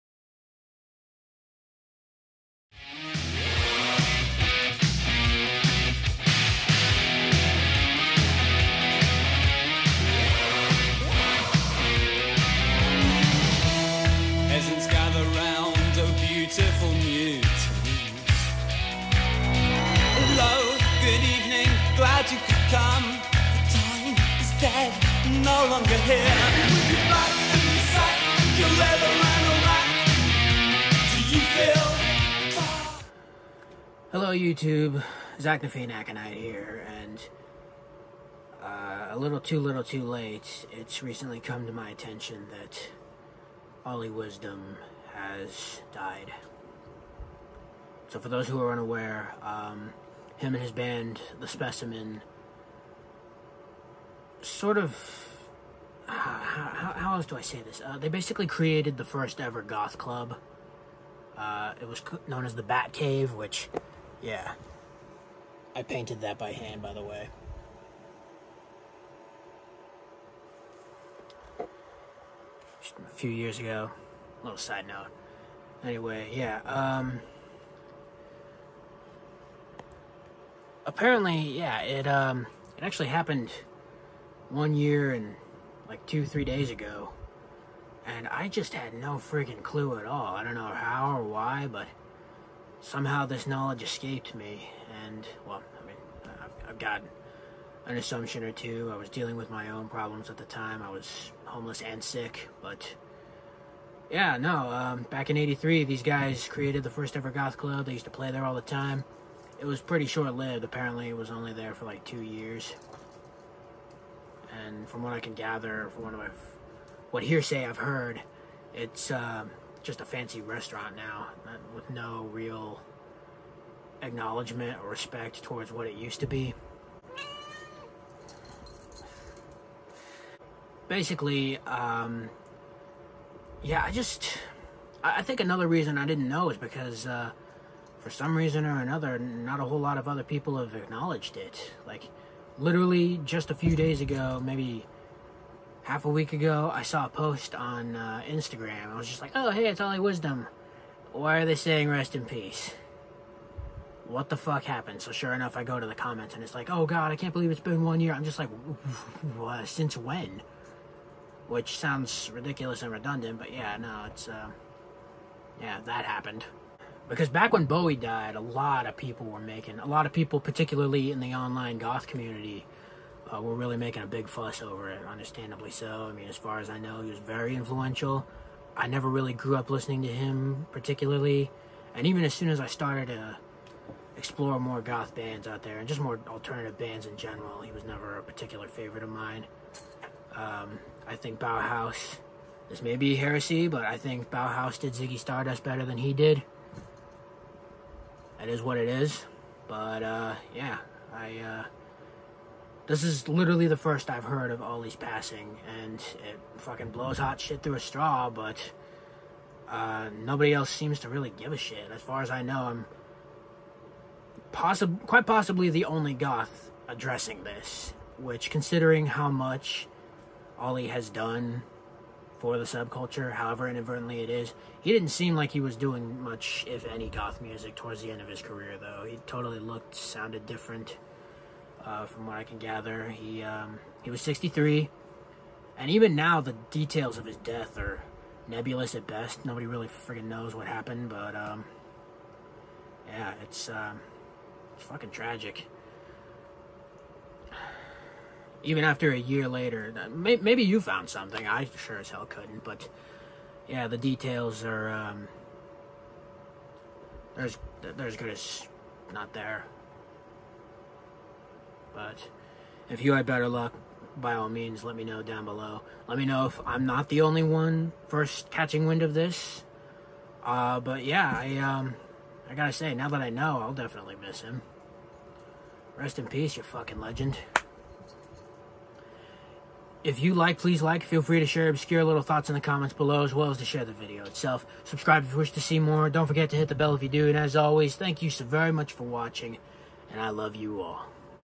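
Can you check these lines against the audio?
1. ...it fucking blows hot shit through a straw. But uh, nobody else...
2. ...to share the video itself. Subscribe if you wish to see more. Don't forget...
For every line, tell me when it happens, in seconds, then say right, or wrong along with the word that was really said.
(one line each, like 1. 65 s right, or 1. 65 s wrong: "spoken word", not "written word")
1. 206 s right
2. 283 s right.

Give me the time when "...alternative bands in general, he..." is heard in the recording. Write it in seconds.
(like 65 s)
186 s.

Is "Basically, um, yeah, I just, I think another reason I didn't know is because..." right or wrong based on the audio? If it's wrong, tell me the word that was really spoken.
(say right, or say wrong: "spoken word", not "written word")
right.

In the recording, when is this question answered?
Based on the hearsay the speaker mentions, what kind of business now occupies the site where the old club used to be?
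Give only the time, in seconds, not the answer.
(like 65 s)
120 s.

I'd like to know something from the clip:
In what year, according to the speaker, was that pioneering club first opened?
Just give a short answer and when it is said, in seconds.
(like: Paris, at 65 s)
1983, at 105 s.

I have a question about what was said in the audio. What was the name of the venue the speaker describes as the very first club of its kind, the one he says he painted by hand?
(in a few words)
Bat Cave.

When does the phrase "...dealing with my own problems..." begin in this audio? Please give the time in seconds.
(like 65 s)
99 s.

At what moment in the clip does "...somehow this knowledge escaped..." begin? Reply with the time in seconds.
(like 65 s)
92 s.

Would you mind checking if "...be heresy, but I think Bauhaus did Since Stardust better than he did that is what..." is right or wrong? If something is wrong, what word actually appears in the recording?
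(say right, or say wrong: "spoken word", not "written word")
wrong: "Ziggy", not "Since".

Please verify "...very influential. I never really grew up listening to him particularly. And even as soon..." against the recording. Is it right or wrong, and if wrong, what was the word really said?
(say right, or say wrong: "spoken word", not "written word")
right.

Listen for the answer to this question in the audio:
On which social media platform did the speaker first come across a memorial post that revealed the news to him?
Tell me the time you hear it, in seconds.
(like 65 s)
148 s.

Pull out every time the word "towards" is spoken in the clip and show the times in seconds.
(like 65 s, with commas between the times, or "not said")
125 s, 227 s.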